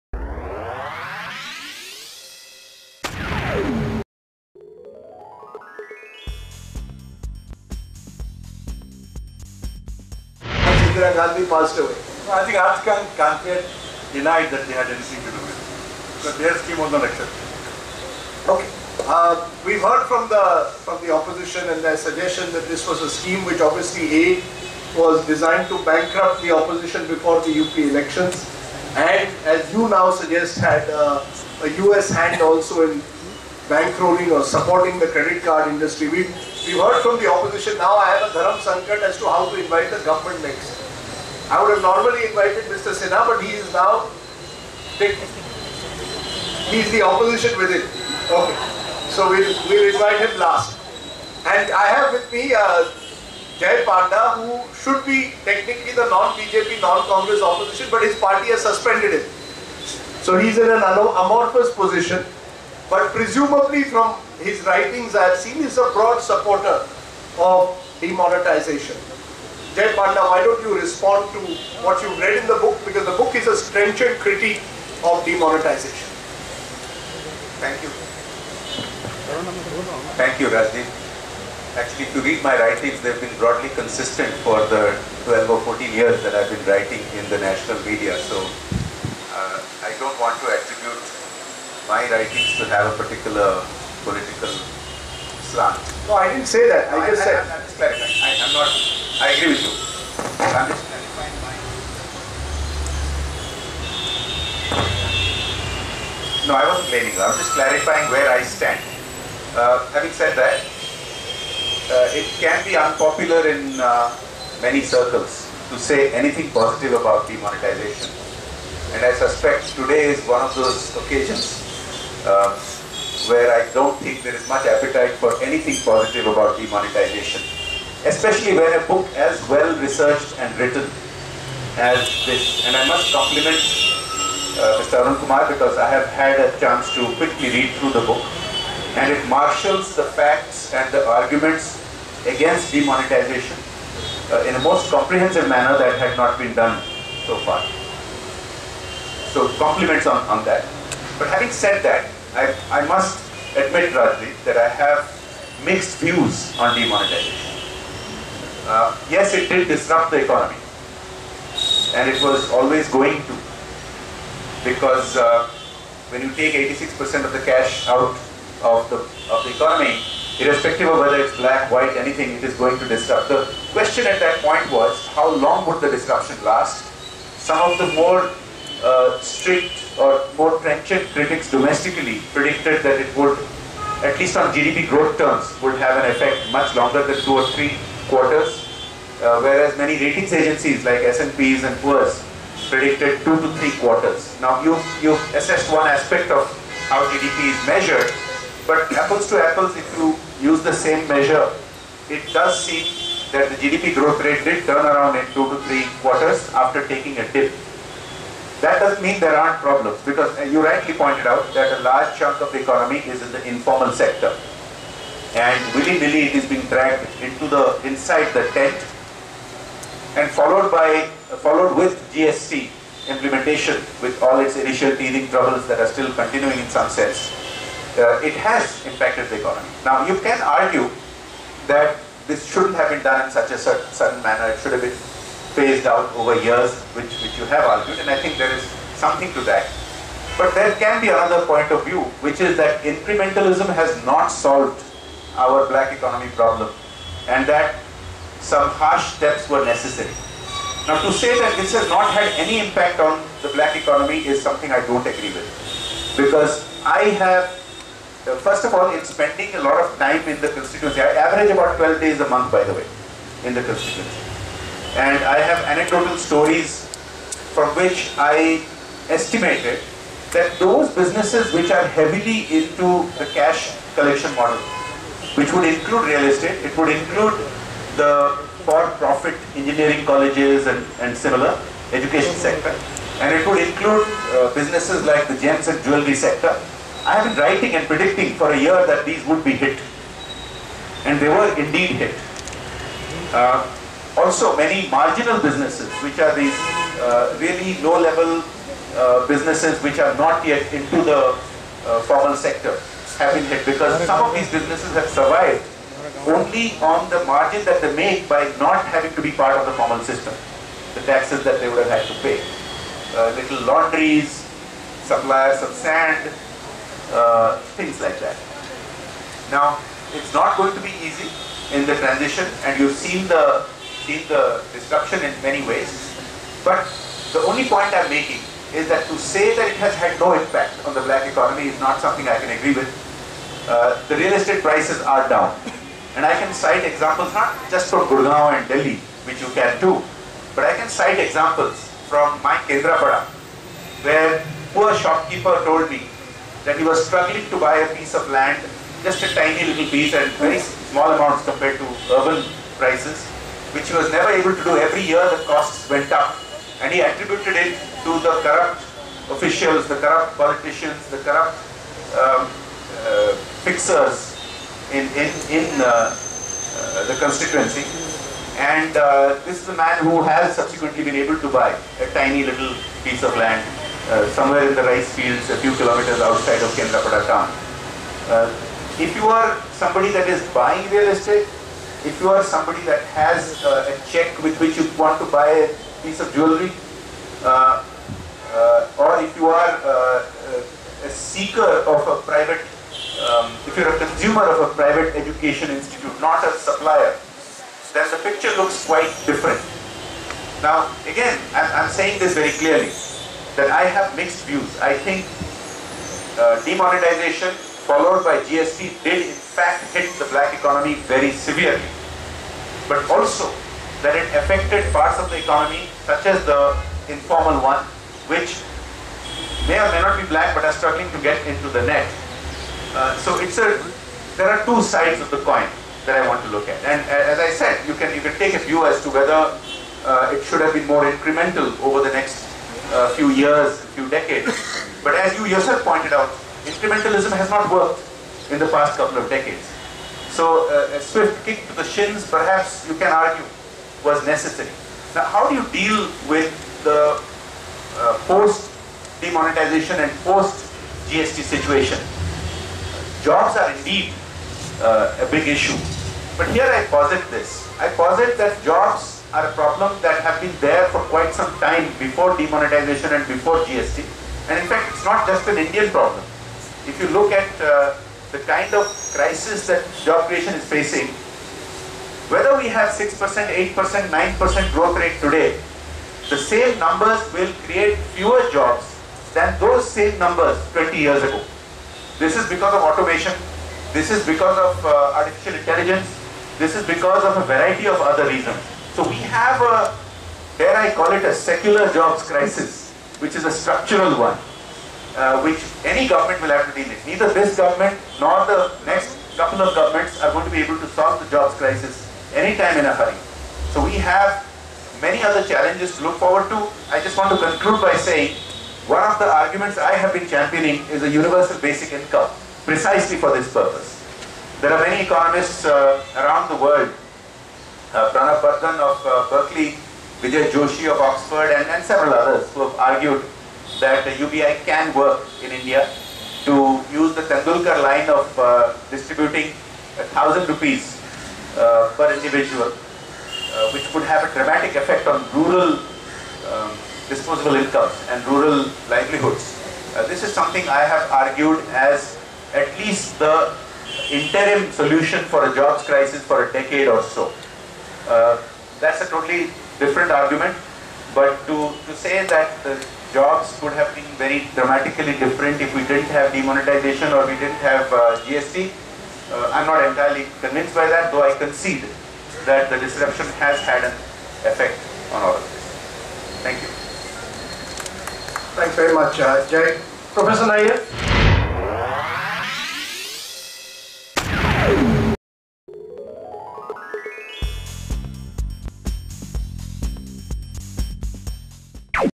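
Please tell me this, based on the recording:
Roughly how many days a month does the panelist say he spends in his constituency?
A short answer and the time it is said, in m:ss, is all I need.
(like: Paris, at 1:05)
12, at 4:21.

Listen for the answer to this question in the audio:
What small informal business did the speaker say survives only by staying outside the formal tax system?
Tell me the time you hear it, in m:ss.
5:13.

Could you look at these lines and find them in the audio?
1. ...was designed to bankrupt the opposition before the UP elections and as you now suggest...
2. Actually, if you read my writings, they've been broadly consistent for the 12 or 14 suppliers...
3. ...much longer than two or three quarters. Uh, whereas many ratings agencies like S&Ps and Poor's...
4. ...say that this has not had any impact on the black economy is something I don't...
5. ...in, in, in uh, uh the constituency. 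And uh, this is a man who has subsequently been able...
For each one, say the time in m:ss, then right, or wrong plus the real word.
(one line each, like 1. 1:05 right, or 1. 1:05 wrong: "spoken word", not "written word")
1. 0:24 right
2. 1:21 wrong: "years", not "suppliers"
3. 3:06 right
4. 4:11 right
5. 6:04 right.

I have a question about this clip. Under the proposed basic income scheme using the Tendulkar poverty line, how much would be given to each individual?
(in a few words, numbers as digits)
1000 rupees.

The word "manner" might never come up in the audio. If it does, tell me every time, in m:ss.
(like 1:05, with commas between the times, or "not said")
2:25, 3:54.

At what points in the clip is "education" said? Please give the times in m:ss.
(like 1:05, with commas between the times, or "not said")
4:41, 6:35.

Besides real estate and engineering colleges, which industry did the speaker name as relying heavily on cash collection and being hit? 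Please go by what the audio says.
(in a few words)
gems and jewelry.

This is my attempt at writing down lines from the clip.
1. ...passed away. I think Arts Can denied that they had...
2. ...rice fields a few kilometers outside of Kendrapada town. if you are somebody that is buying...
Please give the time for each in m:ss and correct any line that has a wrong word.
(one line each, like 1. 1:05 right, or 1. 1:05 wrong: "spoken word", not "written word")
1. 0:11 right
2. 6:14 right.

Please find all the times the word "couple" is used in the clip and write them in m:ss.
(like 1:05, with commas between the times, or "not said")
7:18, 8:19.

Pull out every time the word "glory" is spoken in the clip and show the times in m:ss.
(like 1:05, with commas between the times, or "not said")
not said.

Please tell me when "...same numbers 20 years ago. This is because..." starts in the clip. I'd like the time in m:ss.
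7:59.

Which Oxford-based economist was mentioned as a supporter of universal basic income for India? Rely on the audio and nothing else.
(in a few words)
Vijay Joshi.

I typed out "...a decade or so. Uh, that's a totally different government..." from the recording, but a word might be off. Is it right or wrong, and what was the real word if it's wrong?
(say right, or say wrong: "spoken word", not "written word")
wrong: "argument", not "government".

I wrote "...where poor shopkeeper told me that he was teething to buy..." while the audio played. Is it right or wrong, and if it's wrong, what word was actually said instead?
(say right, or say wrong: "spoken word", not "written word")
wrong: "struggling", not "teething".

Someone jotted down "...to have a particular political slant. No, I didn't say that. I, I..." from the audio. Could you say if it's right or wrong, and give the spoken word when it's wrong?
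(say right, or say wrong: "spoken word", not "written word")
right.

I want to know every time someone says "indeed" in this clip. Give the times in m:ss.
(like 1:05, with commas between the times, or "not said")
4:51, 7:33.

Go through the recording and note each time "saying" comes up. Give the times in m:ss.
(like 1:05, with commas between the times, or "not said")
6:41, 8:27.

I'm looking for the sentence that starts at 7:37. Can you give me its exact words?
I posit that jobs are a problem that have been there for quite some time before demonetization and before GST.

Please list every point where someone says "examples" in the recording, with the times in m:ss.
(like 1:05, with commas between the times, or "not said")
5:36, 5:41.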